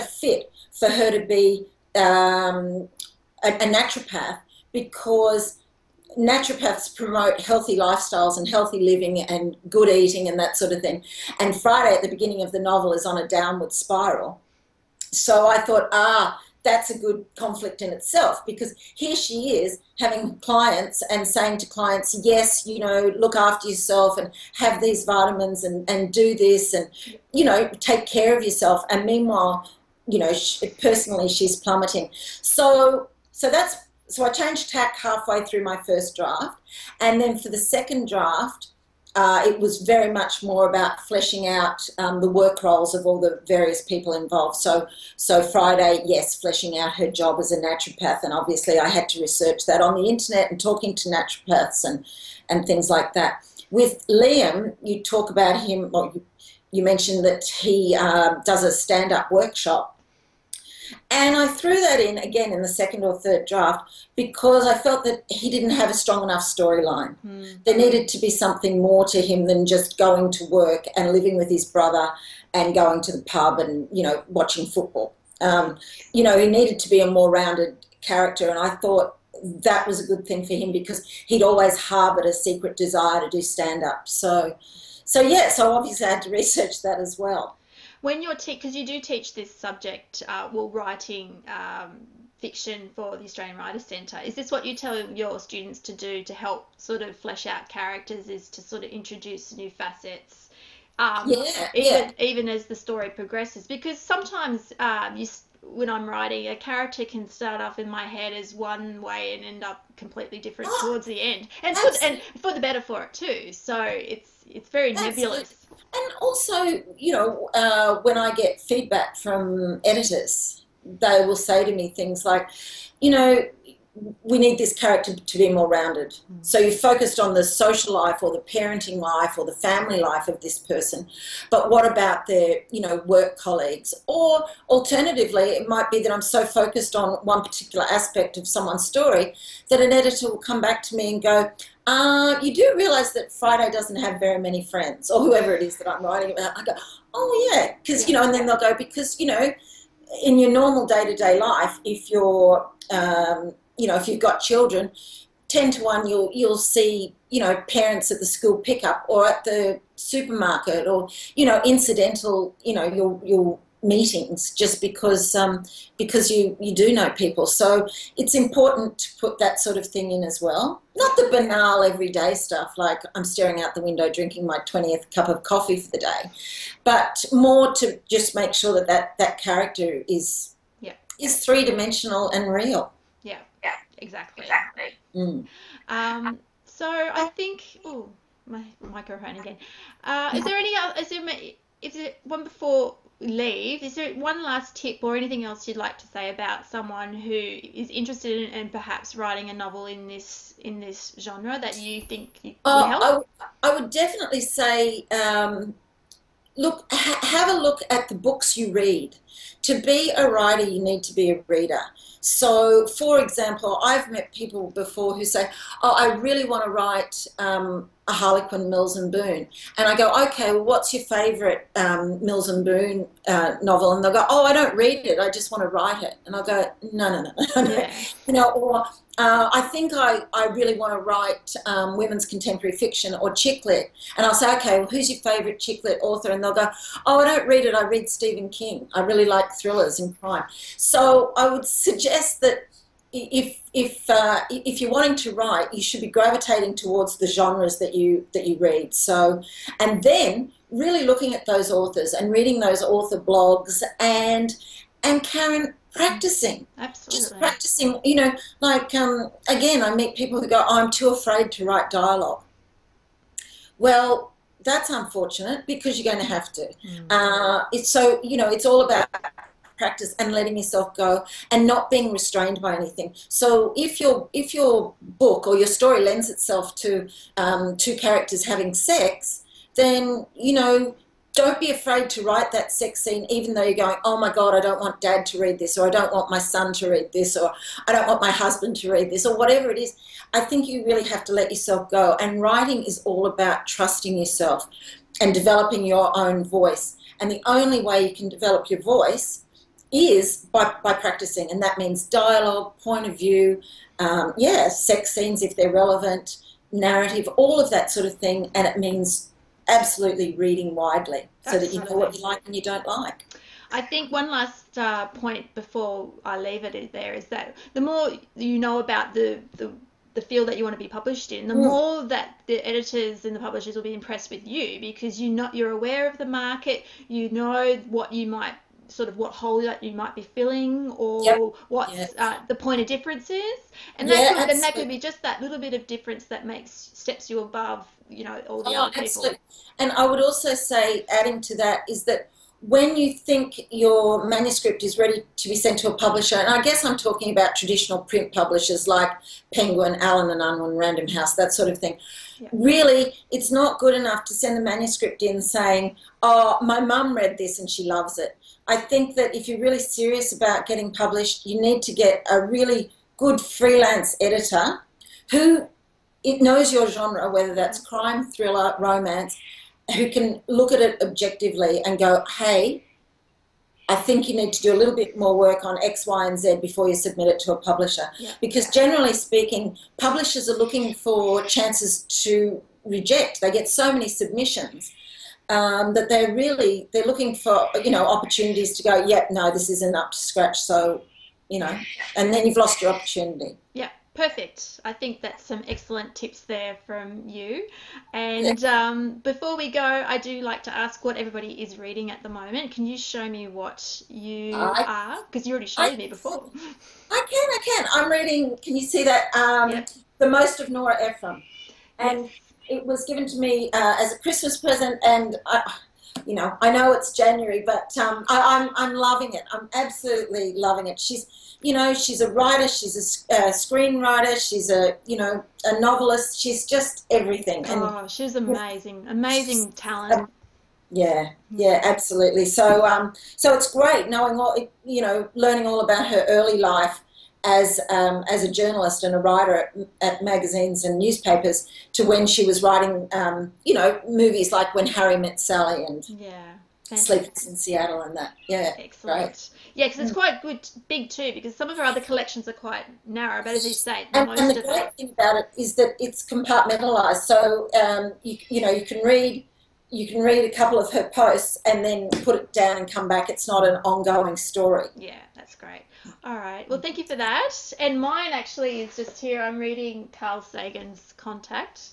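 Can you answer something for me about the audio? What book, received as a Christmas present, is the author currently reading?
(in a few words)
The Most of Nora Ephron.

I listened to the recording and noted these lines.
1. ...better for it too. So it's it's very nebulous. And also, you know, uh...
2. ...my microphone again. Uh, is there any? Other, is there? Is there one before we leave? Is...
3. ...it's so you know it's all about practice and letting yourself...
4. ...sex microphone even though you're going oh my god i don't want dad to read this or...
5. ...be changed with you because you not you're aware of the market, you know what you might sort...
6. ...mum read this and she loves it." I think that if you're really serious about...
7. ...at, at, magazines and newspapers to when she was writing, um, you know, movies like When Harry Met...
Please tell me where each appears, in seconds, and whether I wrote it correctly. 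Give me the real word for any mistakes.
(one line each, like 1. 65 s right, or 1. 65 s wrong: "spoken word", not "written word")
1. 112 s right
2. 188 s right
3. 267 s right
4. 282 s wrong: "scene", not "microphone"
5. 323 s wrong: "impressed", not "changed"
6. 356 s right
7. 439 s right.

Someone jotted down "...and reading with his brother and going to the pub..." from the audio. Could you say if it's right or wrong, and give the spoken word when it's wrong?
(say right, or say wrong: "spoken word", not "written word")
wrong: "living", not "reading".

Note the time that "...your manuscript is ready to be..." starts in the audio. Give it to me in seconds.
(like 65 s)
343 s.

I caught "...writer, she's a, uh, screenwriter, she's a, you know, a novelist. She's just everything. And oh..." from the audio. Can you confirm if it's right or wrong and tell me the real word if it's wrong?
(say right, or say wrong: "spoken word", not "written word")
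right.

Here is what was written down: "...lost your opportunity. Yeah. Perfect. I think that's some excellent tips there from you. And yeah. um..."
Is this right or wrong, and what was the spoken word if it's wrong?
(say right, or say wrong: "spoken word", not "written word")
right.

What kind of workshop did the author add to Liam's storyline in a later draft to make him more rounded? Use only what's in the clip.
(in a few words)
Stand-up workshop.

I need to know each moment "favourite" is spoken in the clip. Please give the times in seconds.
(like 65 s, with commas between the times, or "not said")
221 s, 235 s.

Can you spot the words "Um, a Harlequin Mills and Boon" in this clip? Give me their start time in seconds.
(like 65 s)
217 s.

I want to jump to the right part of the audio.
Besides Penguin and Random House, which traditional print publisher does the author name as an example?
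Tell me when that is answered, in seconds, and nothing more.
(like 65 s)
350 s.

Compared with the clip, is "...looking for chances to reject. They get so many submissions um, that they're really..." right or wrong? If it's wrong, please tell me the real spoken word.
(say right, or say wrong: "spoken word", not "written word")
right.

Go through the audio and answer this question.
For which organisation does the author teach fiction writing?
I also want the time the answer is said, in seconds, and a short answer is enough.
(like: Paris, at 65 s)
Australian Writers Centre, at 93 s.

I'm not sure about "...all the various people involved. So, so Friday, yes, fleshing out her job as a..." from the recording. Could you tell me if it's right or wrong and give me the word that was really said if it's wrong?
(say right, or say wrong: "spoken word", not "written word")
right.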